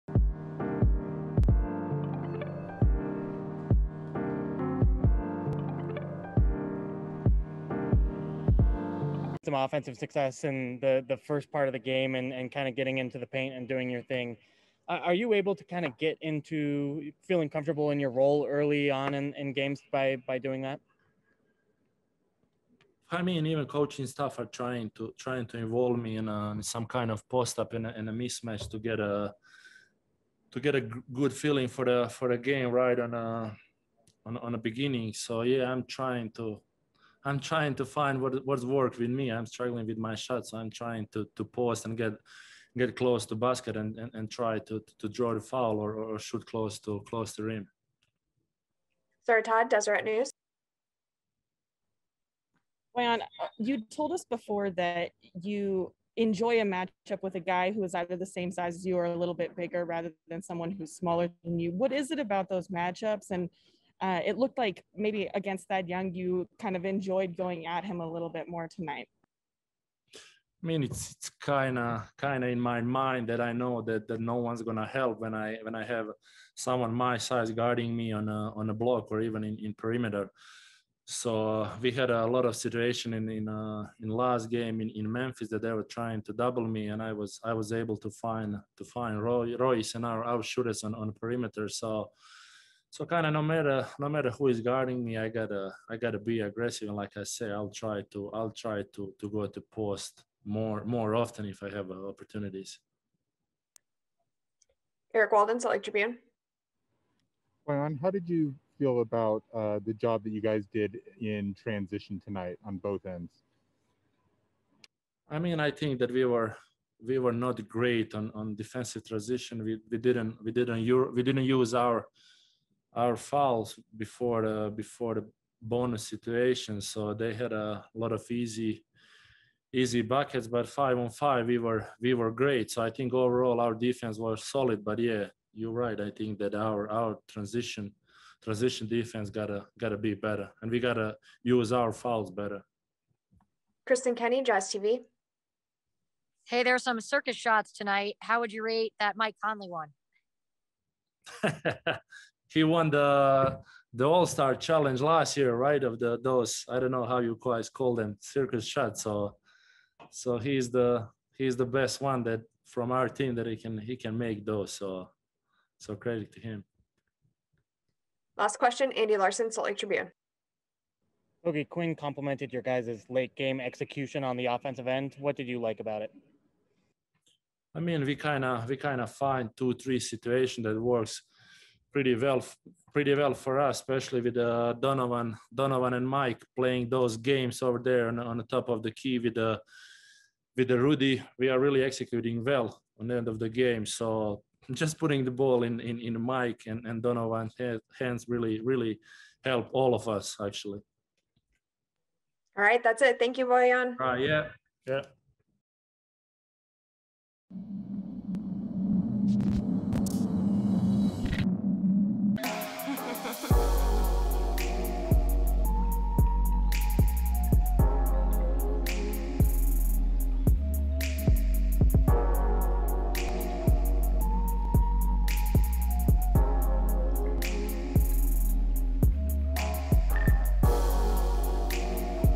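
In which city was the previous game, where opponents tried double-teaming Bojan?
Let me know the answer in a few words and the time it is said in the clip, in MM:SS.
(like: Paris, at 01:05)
Memphis, at 01:25.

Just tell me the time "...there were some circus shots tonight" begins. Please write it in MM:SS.
02:26.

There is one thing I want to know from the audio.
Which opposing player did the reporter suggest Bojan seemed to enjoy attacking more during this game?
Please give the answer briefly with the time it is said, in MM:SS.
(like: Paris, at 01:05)
Thad Young, at 01:05.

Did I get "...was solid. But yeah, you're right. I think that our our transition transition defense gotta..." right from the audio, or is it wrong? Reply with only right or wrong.
right.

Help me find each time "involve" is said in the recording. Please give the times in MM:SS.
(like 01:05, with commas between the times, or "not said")
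00:25.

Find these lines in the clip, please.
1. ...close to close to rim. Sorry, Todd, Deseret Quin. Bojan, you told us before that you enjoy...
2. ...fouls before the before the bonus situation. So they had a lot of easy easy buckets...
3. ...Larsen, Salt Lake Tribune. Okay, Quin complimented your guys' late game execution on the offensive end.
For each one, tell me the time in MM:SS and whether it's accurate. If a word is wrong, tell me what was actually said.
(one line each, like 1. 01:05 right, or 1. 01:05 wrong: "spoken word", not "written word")
1. 00:46 wrong: "News", not "Quin"
2. 02:03 right
3. 02:49 right.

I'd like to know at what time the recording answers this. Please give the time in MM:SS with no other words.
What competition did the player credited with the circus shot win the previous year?
02:34.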